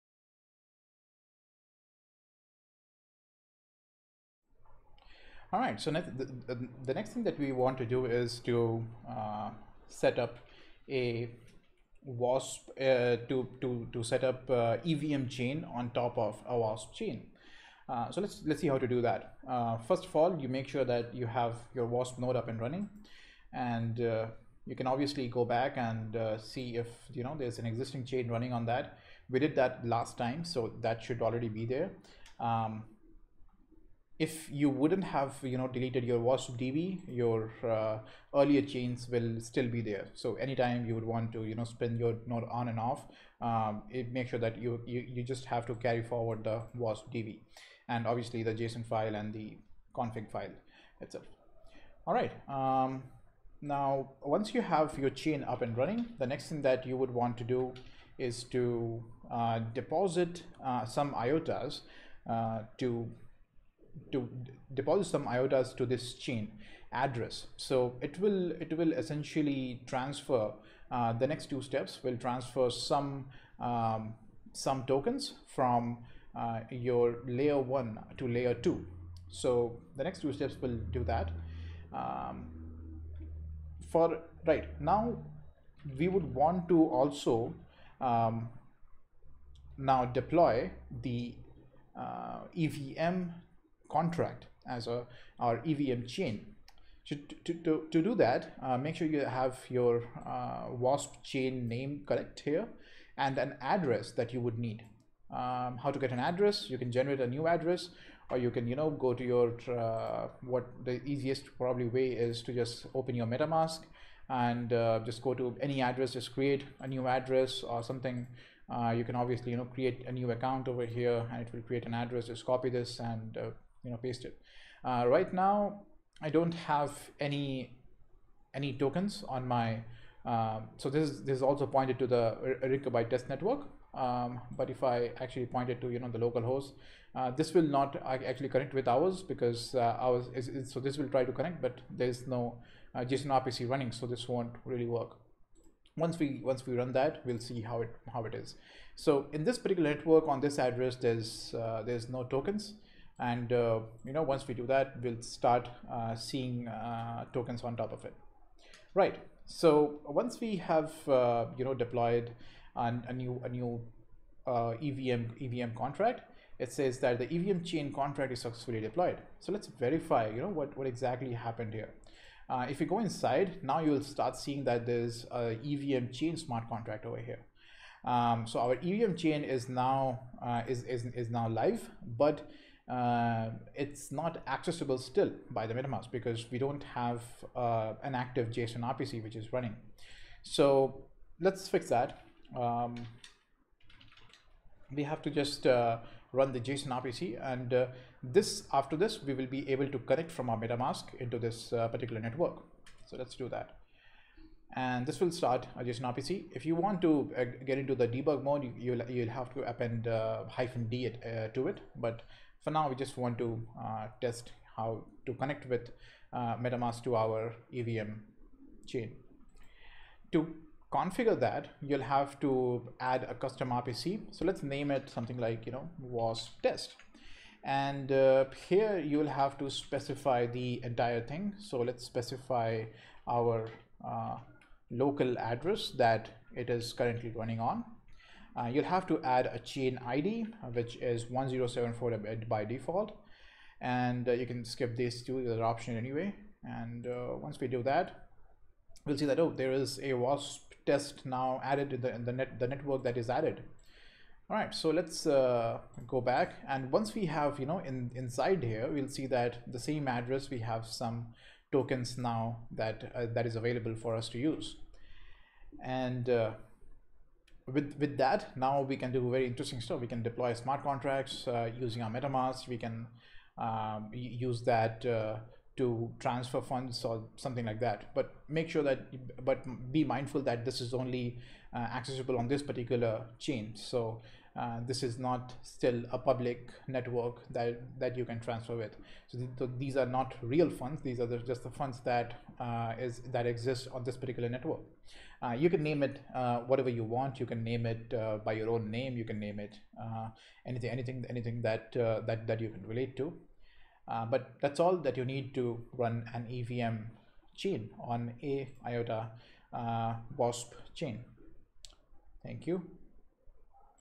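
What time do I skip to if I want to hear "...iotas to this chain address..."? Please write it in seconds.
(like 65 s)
65 s.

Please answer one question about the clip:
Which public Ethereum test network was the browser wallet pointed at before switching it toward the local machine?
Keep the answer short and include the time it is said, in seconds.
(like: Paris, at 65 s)
Rinkeby, at 132 s.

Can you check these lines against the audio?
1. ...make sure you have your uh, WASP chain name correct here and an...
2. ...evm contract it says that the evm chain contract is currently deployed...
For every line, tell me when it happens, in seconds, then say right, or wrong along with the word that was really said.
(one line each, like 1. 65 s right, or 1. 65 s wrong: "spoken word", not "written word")
1. 98 s right
2. 165 s wrong: "successfully", not "currently".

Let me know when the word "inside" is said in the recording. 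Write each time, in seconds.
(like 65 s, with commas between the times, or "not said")
172 s, 258 s.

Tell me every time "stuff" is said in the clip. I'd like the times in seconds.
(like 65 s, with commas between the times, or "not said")
269 s.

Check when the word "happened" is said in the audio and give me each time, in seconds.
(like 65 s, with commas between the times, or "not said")
171 s.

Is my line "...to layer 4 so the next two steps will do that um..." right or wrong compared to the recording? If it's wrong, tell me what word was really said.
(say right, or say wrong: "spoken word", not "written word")
wrong: "2", not "4".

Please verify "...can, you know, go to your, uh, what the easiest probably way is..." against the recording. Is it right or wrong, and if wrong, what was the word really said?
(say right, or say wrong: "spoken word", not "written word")
right.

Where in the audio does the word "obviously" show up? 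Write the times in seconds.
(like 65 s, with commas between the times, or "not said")
24 s, 48 s, 119 s.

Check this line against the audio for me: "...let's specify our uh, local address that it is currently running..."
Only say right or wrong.
right.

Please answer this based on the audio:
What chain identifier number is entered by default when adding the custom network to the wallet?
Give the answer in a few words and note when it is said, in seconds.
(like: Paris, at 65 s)
1074, at 241 s.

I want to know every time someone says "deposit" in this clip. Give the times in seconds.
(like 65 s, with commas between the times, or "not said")
59 s, 64 s.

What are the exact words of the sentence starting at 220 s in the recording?
To configure that, you'll have to add a custom RPC.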